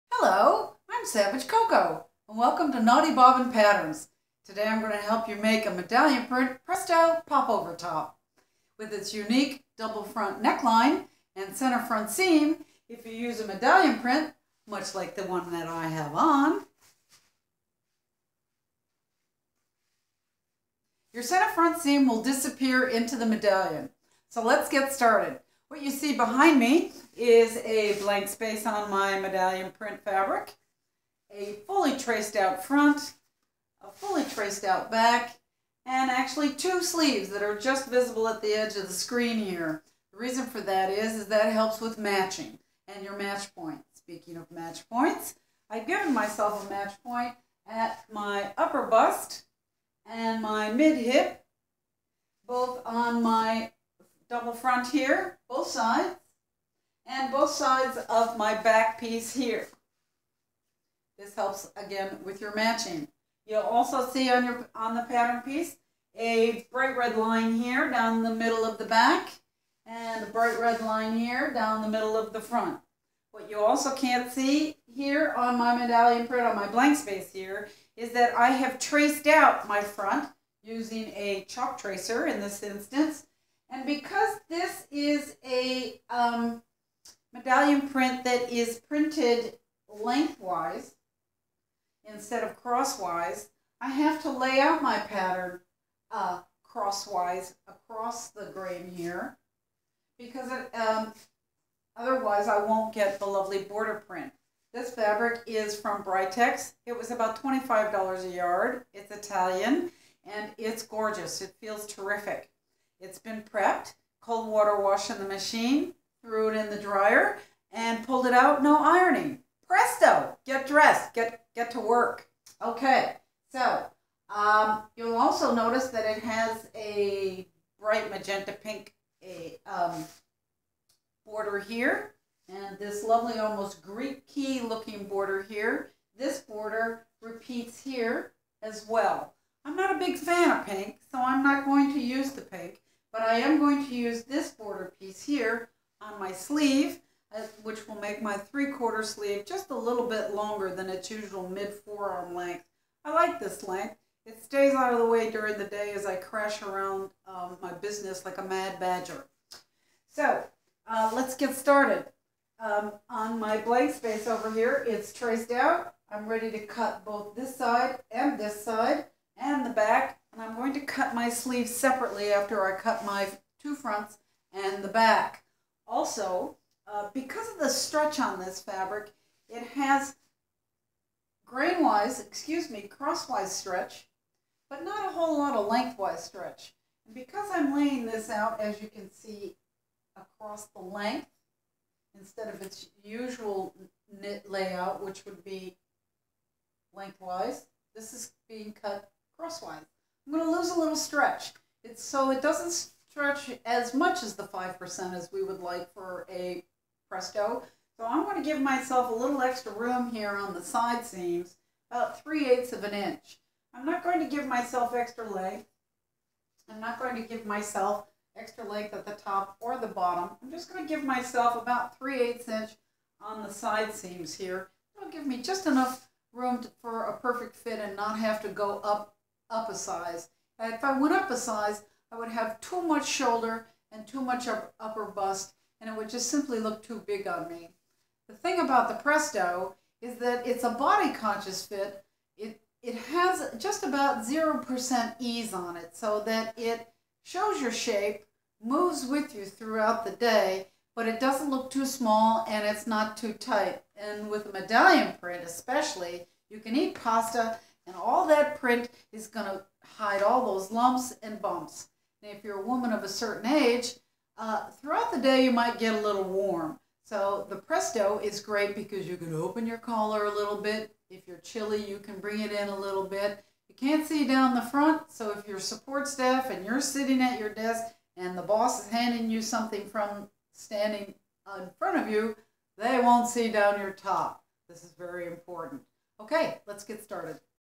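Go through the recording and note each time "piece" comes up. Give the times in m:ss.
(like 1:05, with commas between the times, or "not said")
0:58, 1:05, 2:24.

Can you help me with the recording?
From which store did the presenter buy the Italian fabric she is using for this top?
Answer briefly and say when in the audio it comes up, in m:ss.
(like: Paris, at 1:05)
Britex, at 1:46.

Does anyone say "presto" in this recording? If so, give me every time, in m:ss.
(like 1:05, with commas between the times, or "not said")
0:06, 1:59, 3:27, 3:59, 4:27.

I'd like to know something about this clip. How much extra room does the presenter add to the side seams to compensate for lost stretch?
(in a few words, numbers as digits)
3/8 inch.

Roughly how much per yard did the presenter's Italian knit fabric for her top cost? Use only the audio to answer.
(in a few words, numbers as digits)
$25.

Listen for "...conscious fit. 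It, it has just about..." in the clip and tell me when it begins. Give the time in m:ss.
4:01.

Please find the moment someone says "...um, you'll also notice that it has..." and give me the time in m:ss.
2:04.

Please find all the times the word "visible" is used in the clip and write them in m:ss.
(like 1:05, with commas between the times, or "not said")
0:37.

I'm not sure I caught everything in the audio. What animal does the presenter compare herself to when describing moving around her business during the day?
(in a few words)
Badger.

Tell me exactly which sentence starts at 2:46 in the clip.
I'm ready to cut both this side and this side and the back.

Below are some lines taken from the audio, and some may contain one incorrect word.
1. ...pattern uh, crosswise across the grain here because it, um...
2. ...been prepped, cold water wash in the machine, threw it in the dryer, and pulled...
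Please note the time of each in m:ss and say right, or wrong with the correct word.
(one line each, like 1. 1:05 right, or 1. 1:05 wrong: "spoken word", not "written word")
1. 1:34 right
2. 1:53 right.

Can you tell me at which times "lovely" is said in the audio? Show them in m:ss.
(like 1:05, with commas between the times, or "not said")
1:43, 2:13.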